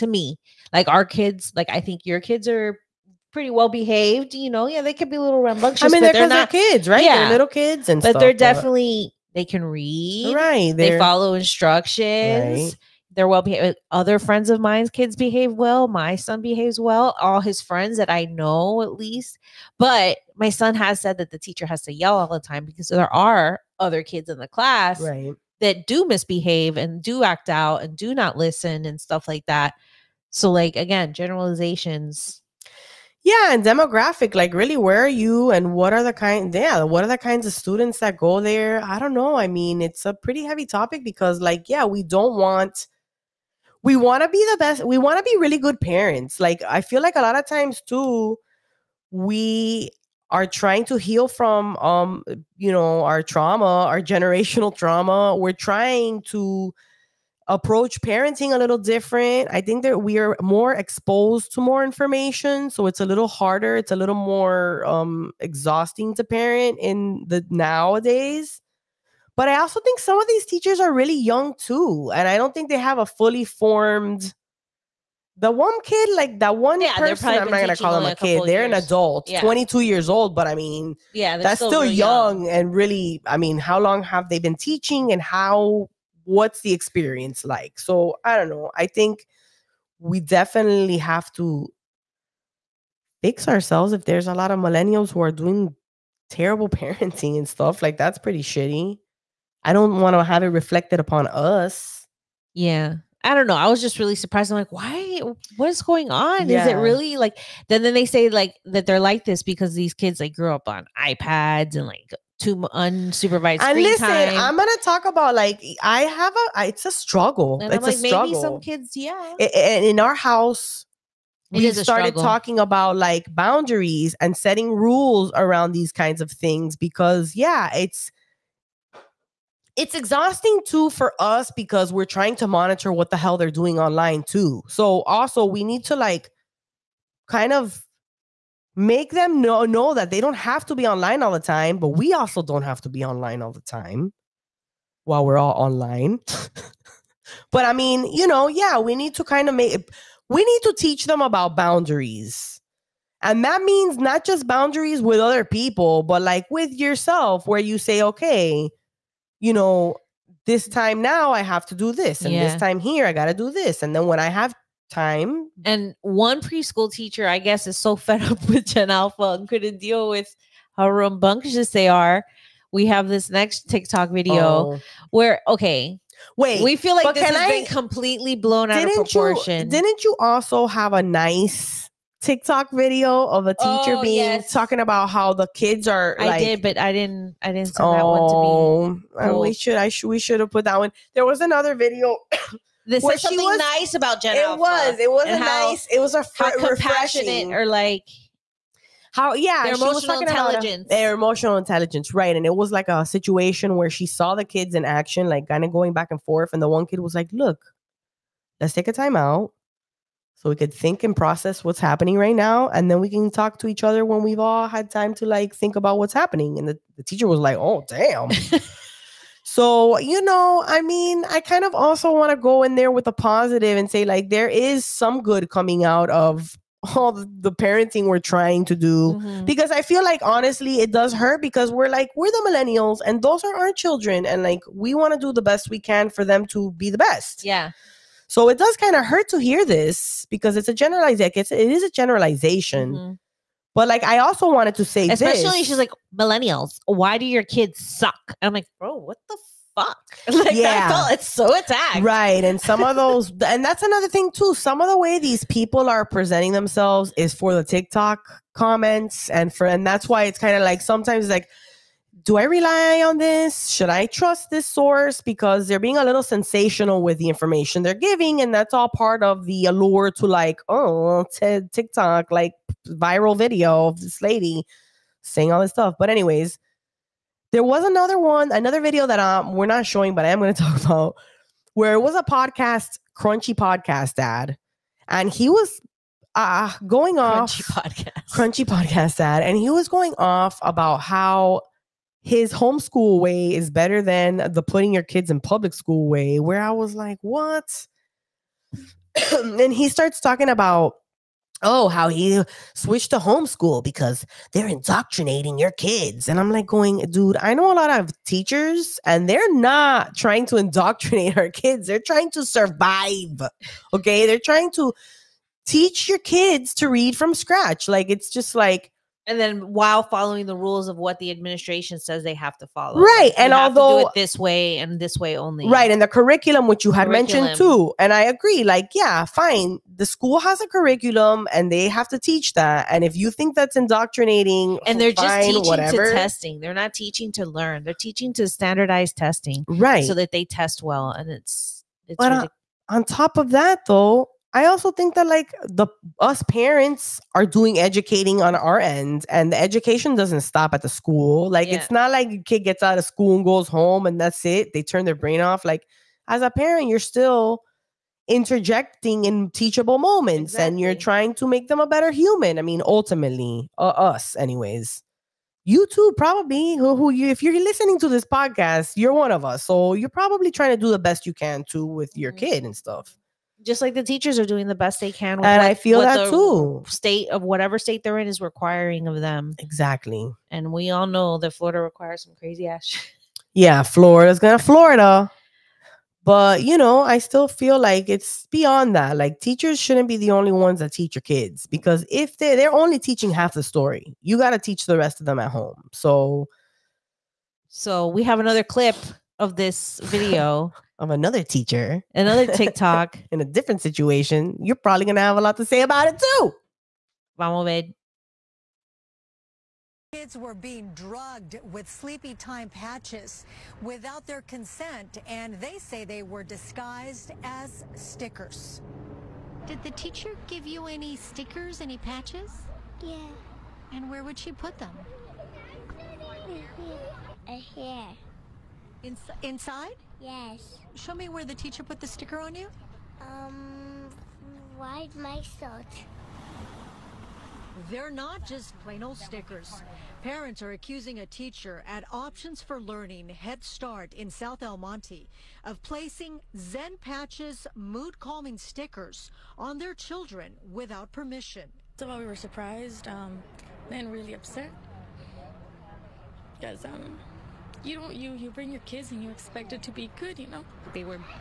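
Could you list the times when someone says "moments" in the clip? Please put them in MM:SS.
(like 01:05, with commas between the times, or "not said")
05:59.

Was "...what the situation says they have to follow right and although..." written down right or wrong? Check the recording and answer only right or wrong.
wrong.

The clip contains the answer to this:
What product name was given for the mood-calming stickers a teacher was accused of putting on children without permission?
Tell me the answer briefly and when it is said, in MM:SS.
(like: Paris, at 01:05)
Zen Patches, at 07:26.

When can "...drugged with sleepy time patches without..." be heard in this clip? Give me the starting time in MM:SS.
06:50.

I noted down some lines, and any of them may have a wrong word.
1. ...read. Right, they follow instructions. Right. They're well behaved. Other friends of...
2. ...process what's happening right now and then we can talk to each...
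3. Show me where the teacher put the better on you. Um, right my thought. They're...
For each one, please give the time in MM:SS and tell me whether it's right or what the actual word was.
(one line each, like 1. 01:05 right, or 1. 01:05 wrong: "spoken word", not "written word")
1. 00:09 right
2. 03:31 right
3. 07:10 wrong: "sticker", not "better".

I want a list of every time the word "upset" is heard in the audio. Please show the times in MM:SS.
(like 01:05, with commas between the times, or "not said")
07:34.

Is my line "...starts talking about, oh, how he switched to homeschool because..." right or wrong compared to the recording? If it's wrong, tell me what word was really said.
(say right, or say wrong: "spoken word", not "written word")
right.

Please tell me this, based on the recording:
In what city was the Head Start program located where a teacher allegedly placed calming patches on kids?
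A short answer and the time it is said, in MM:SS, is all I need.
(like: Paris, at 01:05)
South El Monte, at 07:24.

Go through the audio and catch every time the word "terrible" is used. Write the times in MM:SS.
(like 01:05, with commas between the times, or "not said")
01:36.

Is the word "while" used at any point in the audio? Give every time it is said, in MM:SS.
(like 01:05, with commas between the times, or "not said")
02:25, 05:19, 07:32.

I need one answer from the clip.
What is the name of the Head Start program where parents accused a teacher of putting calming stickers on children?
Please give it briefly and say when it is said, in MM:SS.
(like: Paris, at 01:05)
Options for Learning, at 07:22.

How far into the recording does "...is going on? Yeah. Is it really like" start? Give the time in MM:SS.
01:45.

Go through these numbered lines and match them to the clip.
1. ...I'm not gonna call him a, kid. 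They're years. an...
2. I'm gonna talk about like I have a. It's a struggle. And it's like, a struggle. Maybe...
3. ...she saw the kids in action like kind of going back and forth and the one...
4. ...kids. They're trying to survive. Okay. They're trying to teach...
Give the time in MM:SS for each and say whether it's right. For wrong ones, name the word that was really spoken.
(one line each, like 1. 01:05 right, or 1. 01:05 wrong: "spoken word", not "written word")
1. 01:17 right
2. 01:54 right
3. 03:23 right
4. 05:11 right.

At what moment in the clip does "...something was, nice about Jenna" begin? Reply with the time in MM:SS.
03:13.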